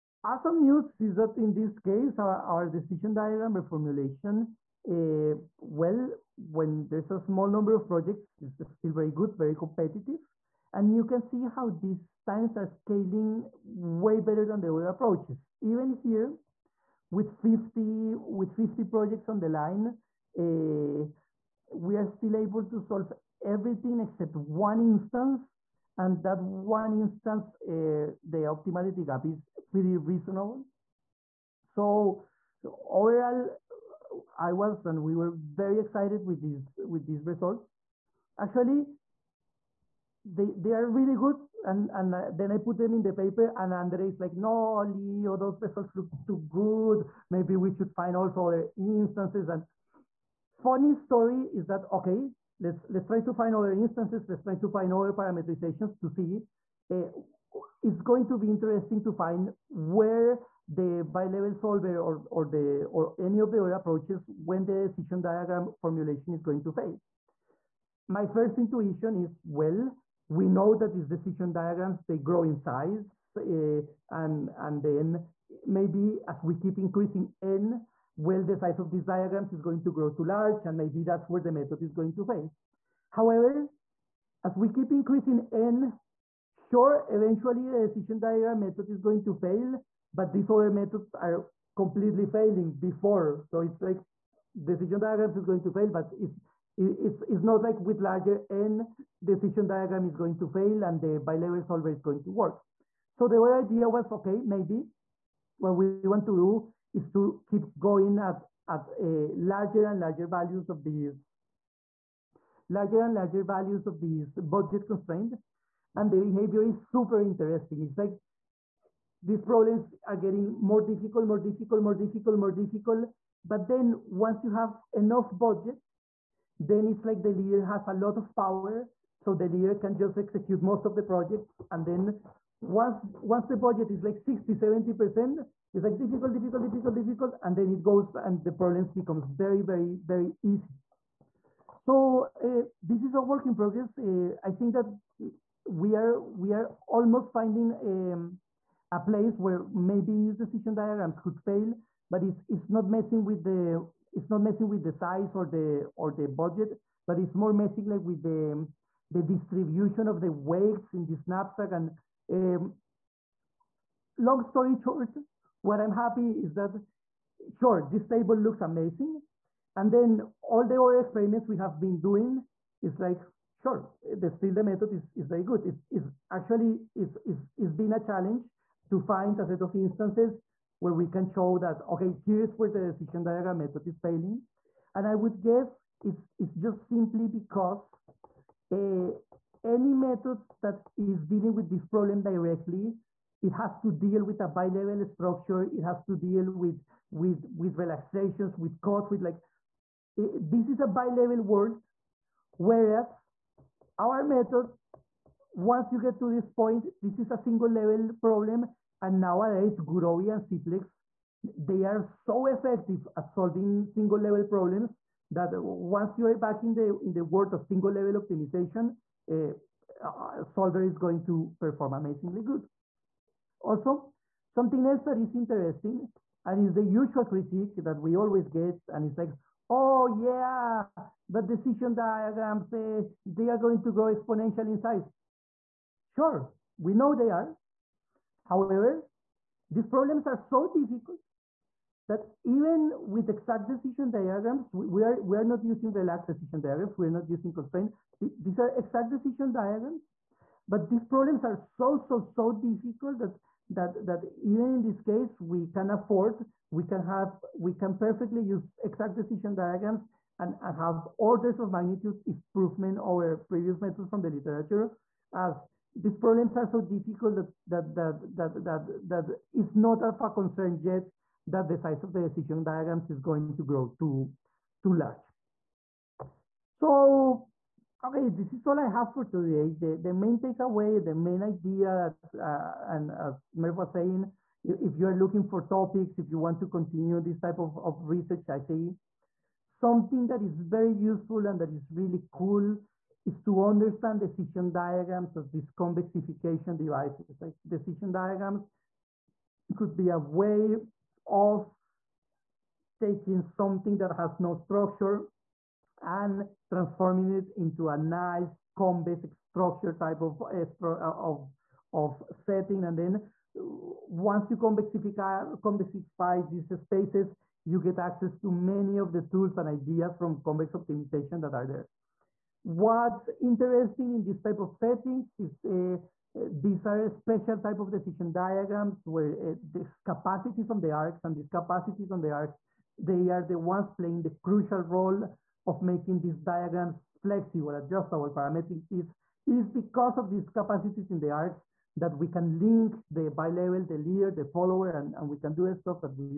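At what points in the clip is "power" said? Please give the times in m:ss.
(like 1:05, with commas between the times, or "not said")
2:08.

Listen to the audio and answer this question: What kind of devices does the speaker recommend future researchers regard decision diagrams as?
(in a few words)
convexification devices.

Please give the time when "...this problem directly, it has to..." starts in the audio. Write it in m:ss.
3:11.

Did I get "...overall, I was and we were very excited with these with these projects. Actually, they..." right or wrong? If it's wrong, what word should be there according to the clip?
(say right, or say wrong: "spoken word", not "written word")
wrong: "results", not "projects".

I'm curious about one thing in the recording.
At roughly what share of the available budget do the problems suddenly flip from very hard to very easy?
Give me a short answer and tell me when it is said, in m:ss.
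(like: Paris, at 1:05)
60, 70%, at 2:14.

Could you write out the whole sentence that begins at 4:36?
So okay, this is all I have for today.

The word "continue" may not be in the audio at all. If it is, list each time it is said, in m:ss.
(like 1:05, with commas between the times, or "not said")
4:46.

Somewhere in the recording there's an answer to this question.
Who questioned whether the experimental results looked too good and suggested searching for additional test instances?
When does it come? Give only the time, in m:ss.
0:43.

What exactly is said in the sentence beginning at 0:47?
Maybe we should find also other instances." And funny story is that okay, let's let's try to find other instances.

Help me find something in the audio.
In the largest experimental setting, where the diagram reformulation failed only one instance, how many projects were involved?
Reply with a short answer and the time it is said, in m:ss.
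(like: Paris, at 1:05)
50, at 0:18.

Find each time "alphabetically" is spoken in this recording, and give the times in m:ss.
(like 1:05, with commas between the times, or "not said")
not said.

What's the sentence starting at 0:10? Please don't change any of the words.
And you can see how these times are scaling way better than the other approaches.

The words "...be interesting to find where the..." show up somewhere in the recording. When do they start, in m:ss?
0:58.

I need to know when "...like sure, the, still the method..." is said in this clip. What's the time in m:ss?
2:52.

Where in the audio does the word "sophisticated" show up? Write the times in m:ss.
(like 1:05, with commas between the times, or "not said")
not said.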